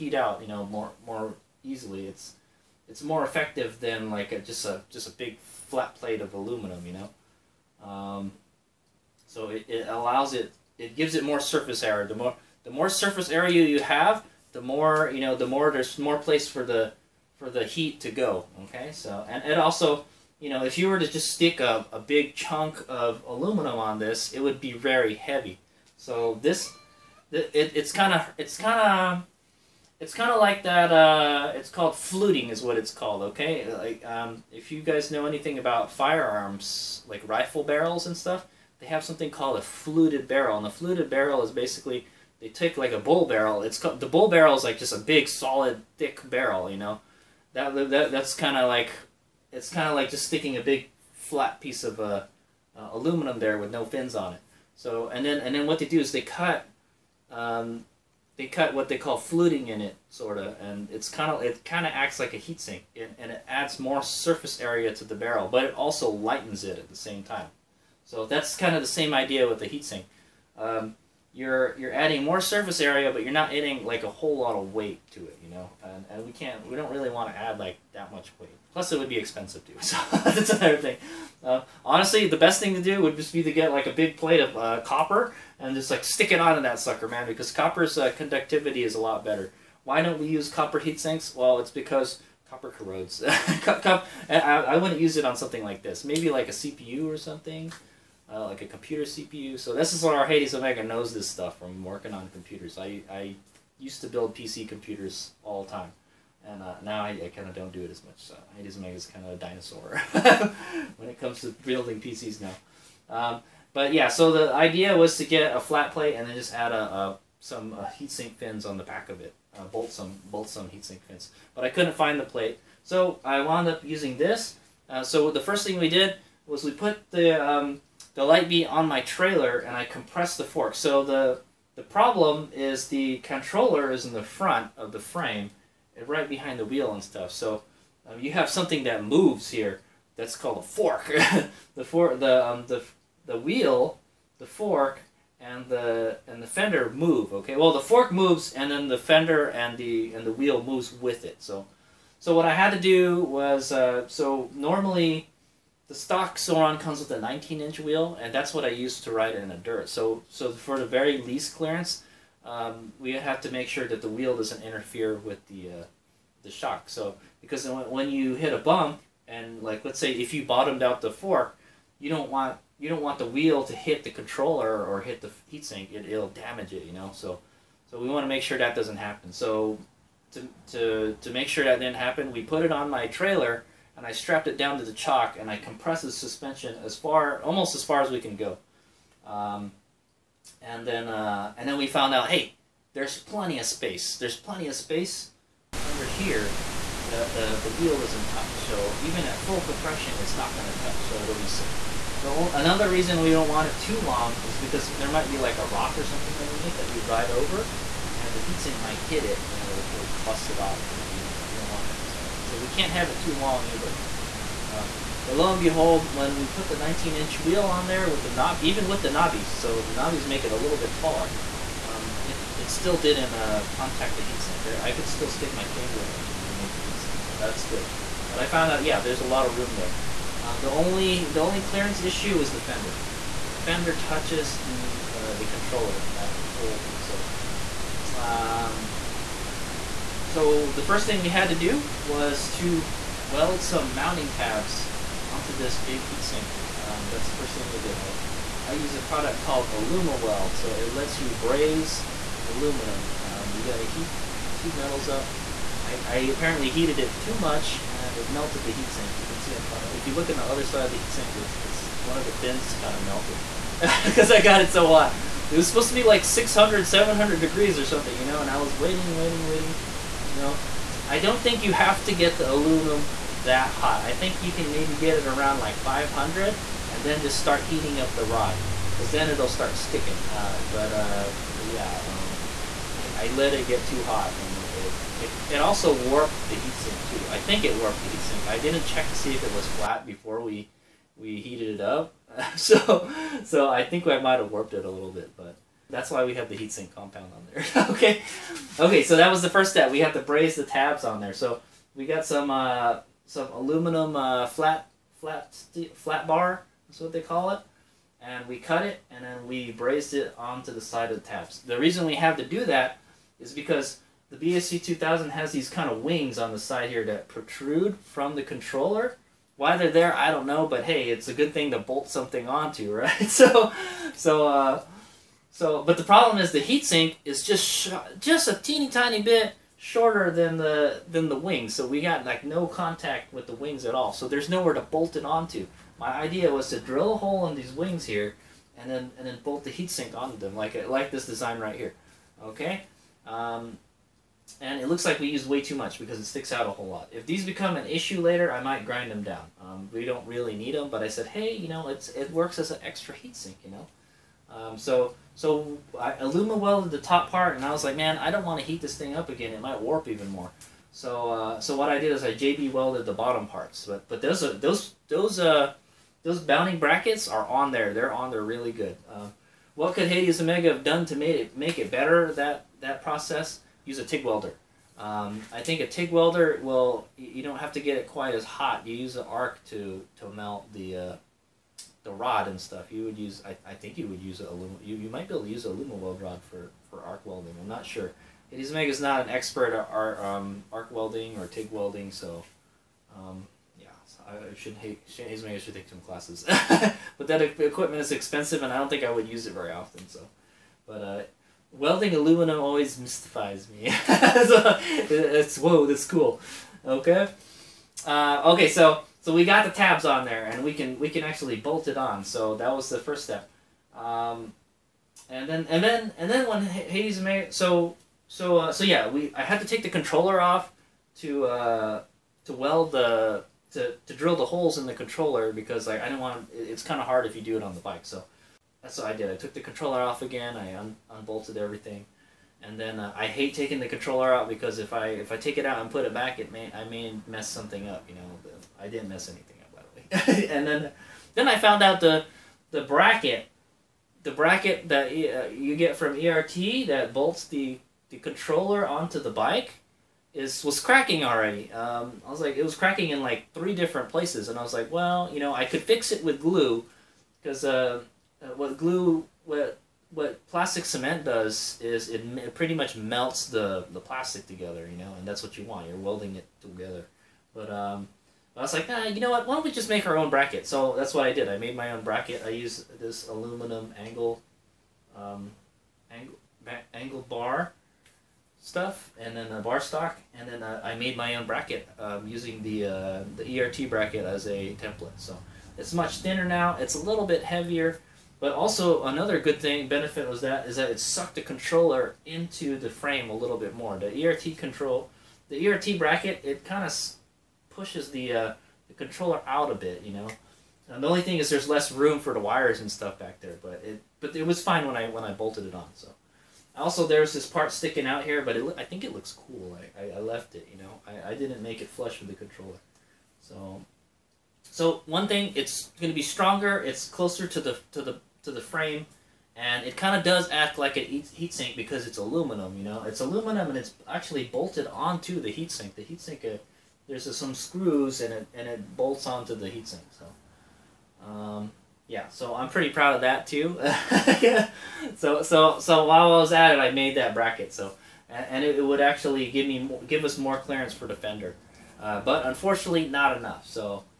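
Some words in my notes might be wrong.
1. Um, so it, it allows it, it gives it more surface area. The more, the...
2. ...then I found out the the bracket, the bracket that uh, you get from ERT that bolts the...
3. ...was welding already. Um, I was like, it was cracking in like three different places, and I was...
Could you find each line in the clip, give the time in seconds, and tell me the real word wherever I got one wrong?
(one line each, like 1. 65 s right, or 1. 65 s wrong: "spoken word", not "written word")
1. 7 s right
2. 441 s right
3. 450 s wrong: "cracking", not "welding".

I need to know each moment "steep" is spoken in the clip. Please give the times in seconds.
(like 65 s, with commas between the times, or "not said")
not said.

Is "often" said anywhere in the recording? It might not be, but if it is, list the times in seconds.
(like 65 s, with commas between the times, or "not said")
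399 s.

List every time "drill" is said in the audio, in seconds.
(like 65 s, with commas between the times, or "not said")
336 s, 424 s.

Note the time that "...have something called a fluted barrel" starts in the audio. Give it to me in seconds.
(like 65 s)
38 s.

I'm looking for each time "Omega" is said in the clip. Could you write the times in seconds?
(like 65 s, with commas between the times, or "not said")
100 s, 108 s, 370 s.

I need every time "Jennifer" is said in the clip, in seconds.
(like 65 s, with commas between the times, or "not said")
not said.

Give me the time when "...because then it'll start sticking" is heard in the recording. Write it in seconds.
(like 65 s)
278 s.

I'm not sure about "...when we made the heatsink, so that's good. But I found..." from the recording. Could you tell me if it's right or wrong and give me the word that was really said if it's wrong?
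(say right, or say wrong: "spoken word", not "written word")
right.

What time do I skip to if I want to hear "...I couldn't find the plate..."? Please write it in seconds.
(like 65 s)
121 s.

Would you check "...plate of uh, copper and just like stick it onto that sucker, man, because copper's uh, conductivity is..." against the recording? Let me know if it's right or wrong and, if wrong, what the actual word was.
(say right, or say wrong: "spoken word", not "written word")
right.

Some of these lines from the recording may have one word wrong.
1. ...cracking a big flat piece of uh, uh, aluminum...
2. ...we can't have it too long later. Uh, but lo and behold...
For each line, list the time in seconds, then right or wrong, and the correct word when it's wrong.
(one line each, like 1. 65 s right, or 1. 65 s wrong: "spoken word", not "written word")
1. 50 s wrong: "sticking", not "cracking"
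2. 212 s wrong: "either", not "later".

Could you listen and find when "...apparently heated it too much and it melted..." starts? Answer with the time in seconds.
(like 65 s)
256 s.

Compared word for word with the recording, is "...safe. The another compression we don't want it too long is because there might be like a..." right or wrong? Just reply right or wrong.
wrong.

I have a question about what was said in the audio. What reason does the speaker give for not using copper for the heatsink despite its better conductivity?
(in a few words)
copper corrodes.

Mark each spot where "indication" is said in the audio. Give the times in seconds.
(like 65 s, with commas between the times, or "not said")
not said.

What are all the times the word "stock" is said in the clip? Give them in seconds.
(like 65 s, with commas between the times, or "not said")
155 s, 479 s.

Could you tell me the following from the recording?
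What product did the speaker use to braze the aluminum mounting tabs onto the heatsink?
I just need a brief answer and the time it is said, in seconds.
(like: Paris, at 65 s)
AlumaWeld, at 249 s.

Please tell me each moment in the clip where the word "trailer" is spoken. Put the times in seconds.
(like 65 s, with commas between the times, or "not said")
129 s, 183 s.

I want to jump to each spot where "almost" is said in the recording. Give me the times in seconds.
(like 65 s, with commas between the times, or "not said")
187 s.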